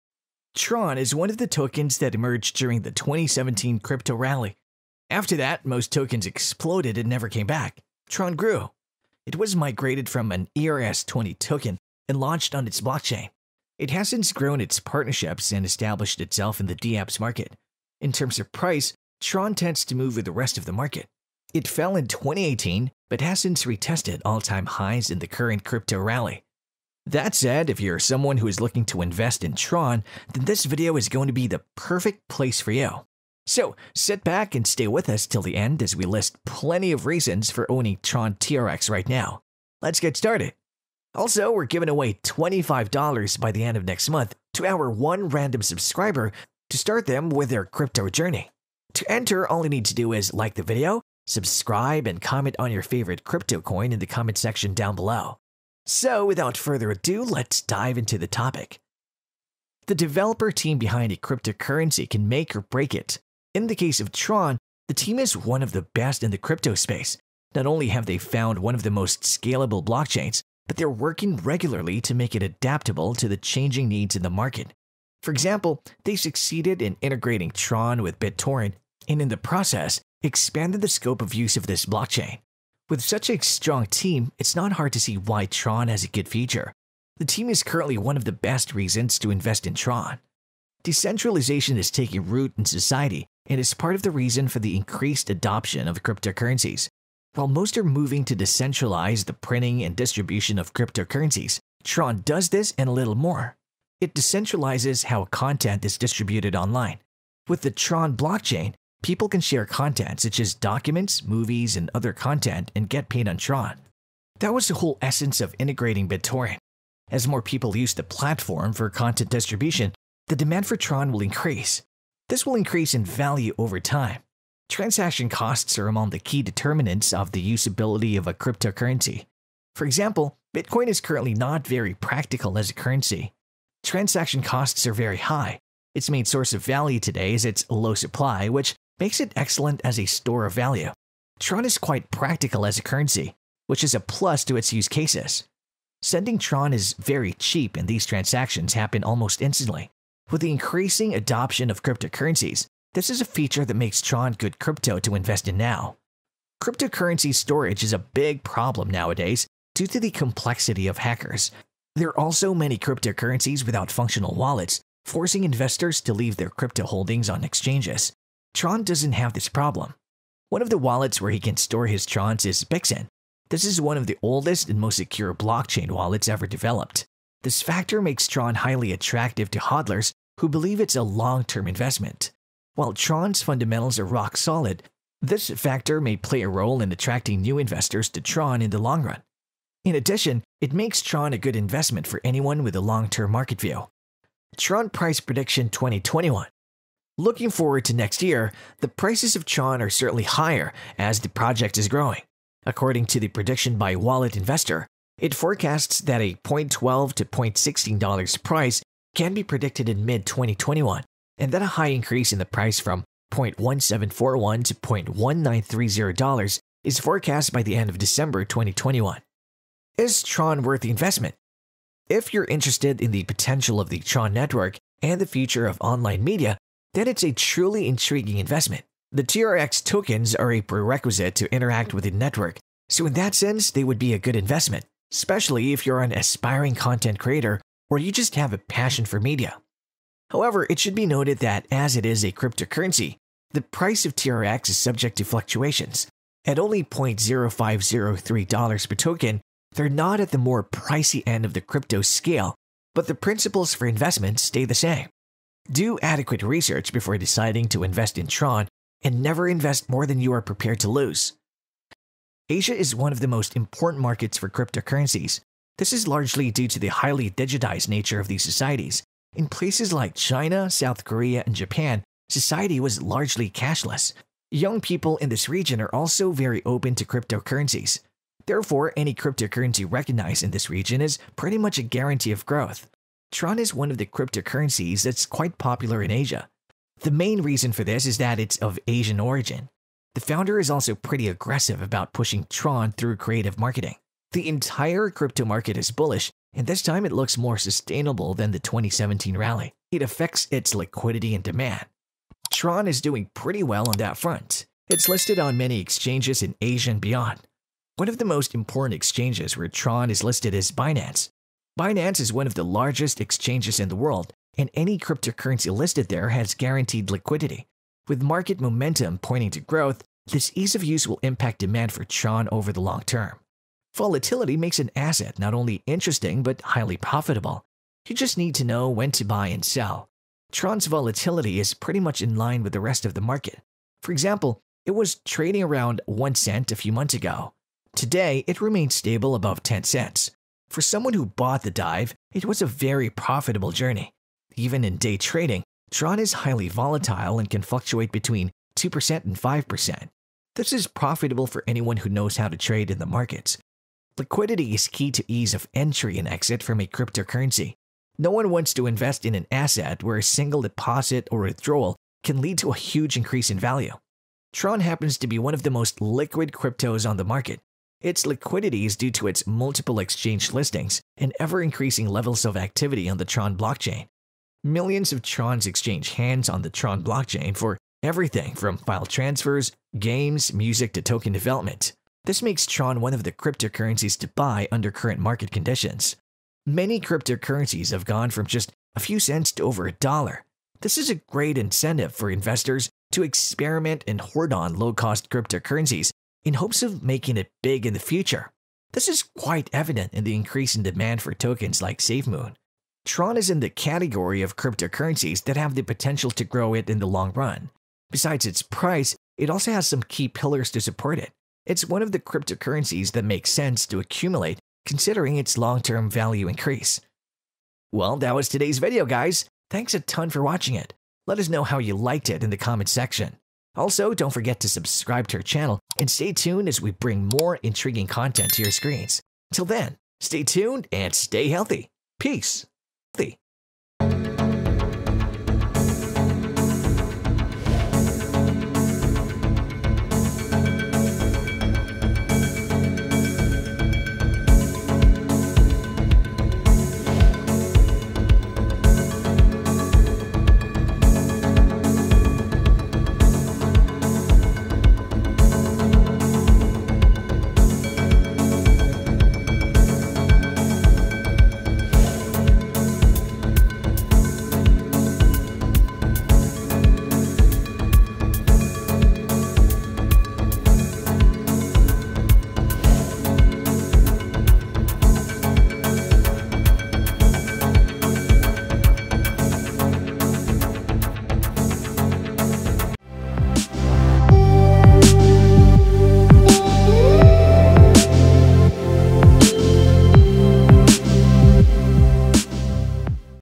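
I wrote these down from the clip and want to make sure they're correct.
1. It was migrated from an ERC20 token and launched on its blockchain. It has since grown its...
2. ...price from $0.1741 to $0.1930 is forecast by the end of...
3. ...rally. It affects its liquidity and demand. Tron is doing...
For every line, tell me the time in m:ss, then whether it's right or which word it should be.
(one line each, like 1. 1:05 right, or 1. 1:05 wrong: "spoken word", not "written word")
1. 0:09 right
2. 3:32 right
3. 4:59 right.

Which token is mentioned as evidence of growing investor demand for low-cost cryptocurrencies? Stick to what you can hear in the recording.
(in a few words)
SafeMoon.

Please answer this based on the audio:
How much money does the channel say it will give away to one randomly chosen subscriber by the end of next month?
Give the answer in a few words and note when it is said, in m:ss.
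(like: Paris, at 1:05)
$25, at 0:42.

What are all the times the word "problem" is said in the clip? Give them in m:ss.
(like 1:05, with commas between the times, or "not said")
2:38, 2:49.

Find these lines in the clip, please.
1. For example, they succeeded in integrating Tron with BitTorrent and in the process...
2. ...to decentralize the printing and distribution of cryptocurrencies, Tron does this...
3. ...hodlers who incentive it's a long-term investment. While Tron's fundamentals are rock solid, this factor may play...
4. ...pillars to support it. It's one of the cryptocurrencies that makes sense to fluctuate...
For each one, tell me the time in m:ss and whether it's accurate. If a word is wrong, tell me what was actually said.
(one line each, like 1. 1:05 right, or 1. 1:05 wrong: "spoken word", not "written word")
1. 1:15 right
2. 1:38 right
3. 2:59 wrong: "believe", not "incentive"
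4. 6:50 wrong: "accumulate", not "fluctuate".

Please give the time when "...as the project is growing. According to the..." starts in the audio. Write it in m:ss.
3:20.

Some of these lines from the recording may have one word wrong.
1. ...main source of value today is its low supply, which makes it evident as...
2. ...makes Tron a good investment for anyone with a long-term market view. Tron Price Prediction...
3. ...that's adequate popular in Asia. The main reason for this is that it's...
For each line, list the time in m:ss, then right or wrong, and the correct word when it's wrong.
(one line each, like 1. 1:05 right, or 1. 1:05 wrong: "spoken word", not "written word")
1. 2:16 wrong: "excellent", not "evident"
2. 3:10 right
3. 4:45 wrong: "quite", not "adequate".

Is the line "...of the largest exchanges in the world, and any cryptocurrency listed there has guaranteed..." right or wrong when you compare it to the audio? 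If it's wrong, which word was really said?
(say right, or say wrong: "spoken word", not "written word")
right.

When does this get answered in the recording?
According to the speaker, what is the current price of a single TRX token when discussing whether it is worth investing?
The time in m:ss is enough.
4:06.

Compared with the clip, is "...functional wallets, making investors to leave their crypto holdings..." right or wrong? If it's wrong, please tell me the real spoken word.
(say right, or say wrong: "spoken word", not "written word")
wrong: "forcing", not "making".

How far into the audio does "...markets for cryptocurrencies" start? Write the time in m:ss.
4:24.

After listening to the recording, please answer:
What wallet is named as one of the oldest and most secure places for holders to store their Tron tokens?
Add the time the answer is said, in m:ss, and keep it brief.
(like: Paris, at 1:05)
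Bixen, at 2:52.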